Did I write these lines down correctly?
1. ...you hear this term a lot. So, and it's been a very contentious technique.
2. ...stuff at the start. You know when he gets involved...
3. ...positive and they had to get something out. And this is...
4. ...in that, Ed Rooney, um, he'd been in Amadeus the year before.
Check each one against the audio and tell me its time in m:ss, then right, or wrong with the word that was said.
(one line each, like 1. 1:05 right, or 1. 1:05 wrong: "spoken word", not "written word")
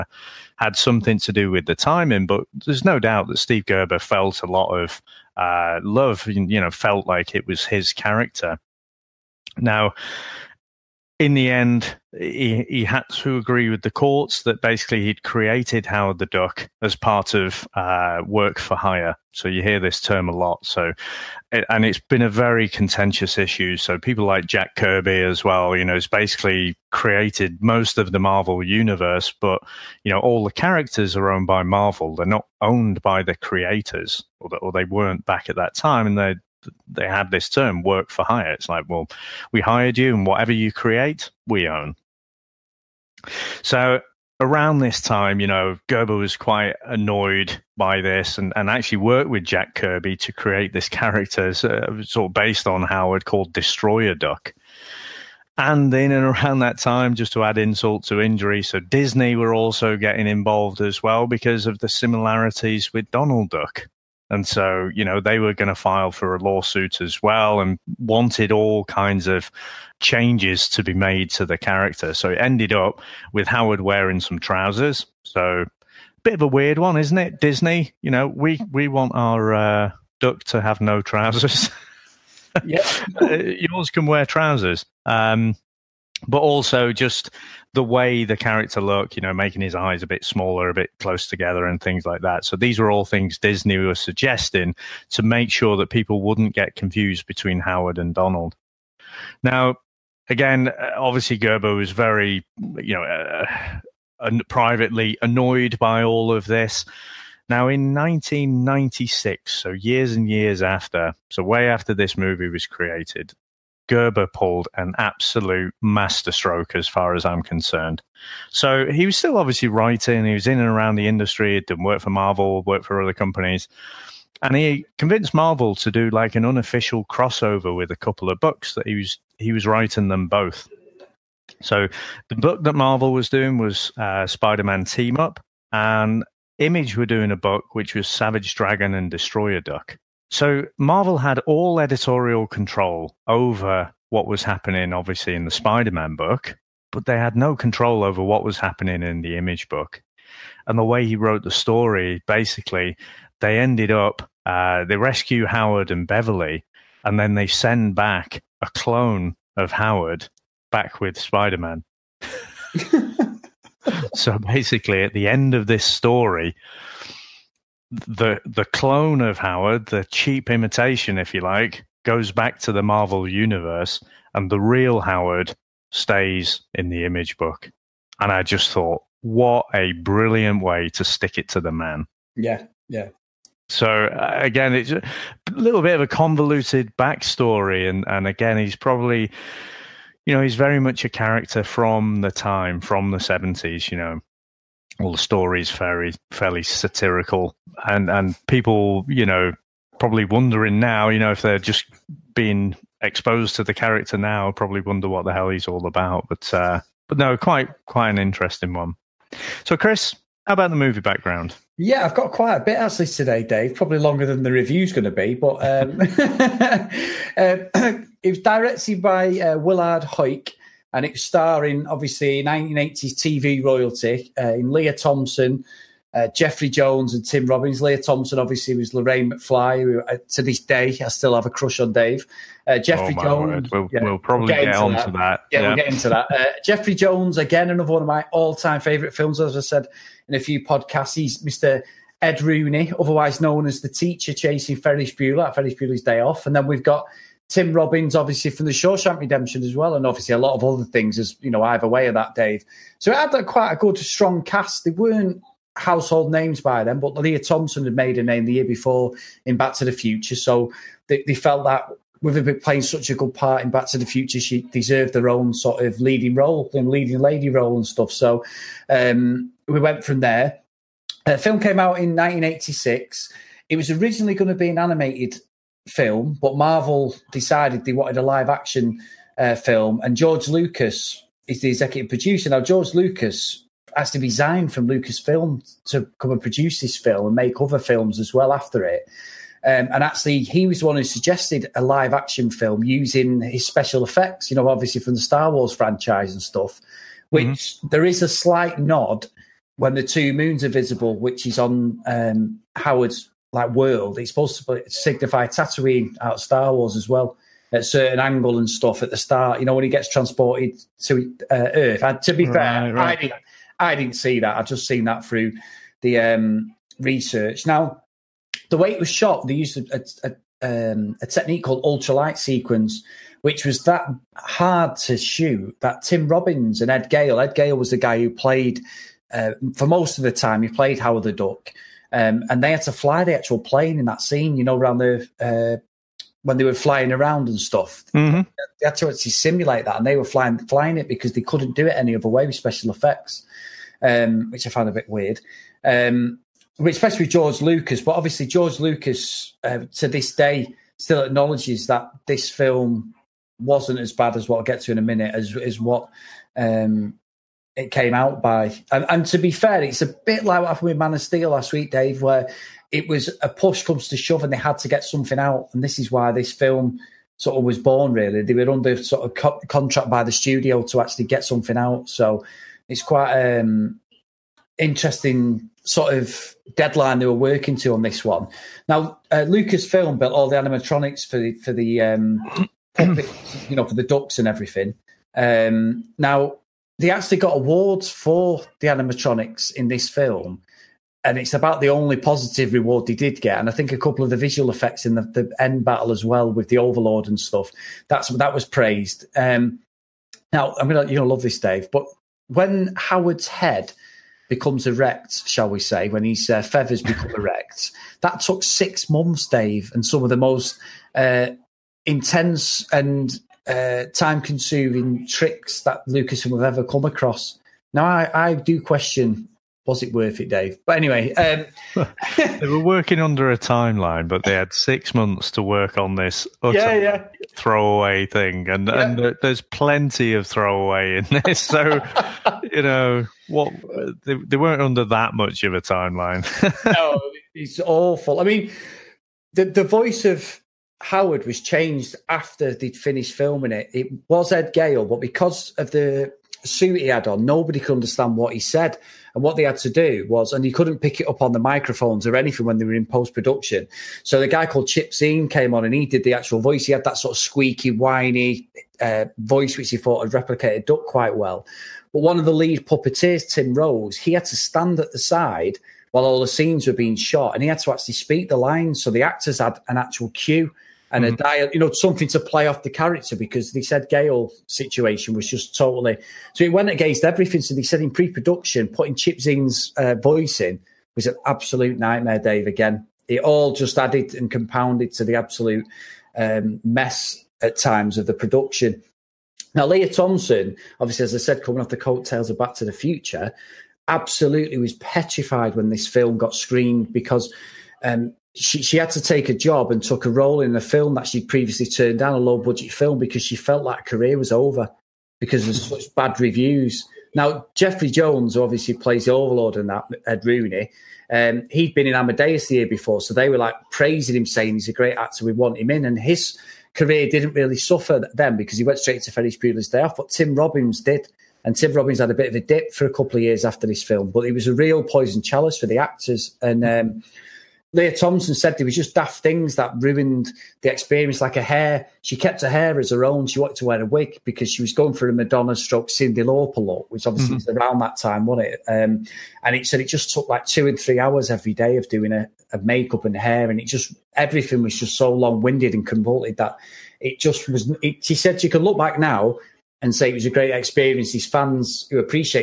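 1. 0:19 wrong: "issue", not "technique"
2. 5:08 wrong: "transported", not "involved"
3. 6:04 wrong: "shove", not "positive"
4. 8:29 right.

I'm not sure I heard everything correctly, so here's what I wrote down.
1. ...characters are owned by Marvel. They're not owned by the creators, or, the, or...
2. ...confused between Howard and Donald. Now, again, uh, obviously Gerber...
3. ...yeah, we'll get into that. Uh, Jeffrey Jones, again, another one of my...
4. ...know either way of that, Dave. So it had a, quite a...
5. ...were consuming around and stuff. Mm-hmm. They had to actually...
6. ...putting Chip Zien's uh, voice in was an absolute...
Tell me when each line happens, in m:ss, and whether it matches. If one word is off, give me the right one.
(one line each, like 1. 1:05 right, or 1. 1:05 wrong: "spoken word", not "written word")
1. 0:30 right
2. 1:36 right
3. 3:55 right
4. 4:11 right
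5. 5:36 wrong: "flying", not "consuming"
6. 7:58 right.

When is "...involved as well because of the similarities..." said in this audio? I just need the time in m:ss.
1:00.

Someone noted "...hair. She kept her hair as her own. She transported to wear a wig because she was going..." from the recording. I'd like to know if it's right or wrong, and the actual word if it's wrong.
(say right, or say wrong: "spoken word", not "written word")
wrong: "wanted", not "transported".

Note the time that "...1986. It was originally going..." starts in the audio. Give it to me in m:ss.
4:32.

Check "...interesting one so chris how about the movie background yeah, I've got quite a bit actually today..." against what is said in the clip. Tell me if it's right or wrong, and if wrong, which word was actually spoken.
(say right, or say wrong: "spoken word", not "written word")
right.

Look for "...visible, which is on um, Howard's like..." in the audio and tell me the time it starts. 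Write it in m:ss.
5:00.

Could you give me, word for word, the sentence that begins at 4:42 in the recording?
Now, George Lucas has to resign from Lucasfilm to come and produce this film and make other films as well after it.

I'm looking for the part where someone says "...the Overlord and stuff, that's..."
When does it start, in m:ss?
6:36.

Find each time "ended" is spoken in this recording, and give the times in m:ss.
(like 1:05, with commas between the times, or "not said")
1:12, 2:33.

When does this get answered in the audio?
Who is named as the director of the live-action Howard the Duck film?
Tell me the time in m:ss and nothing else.
3:39.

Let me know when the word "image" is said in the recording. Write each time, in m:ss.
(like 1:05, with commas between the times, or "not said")
2:16, 2:29, 2:57.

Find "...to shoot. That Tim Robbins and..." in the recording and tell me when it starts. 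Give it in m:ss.
5:24.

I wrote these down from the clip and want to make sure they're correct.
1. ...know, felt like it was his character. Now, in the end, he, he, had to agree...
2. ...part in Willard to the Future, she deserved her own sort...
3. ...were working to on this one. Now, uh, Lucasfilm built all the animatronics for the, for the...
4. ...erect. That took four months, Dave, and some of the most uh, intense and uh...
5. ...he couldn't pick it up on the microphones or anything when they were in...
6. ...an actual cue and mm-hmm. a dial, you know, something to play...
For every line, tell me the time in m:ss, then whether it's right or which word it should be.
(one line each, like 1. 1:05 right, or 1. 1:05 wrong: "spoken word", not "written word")
1. 0:06 right
2. 4:23 wrong: "Back", not "Willard"
3. 6:17 right
4. 6:47 wrong: "six", not "four"
5. 7:30 right
6. 7:49 right.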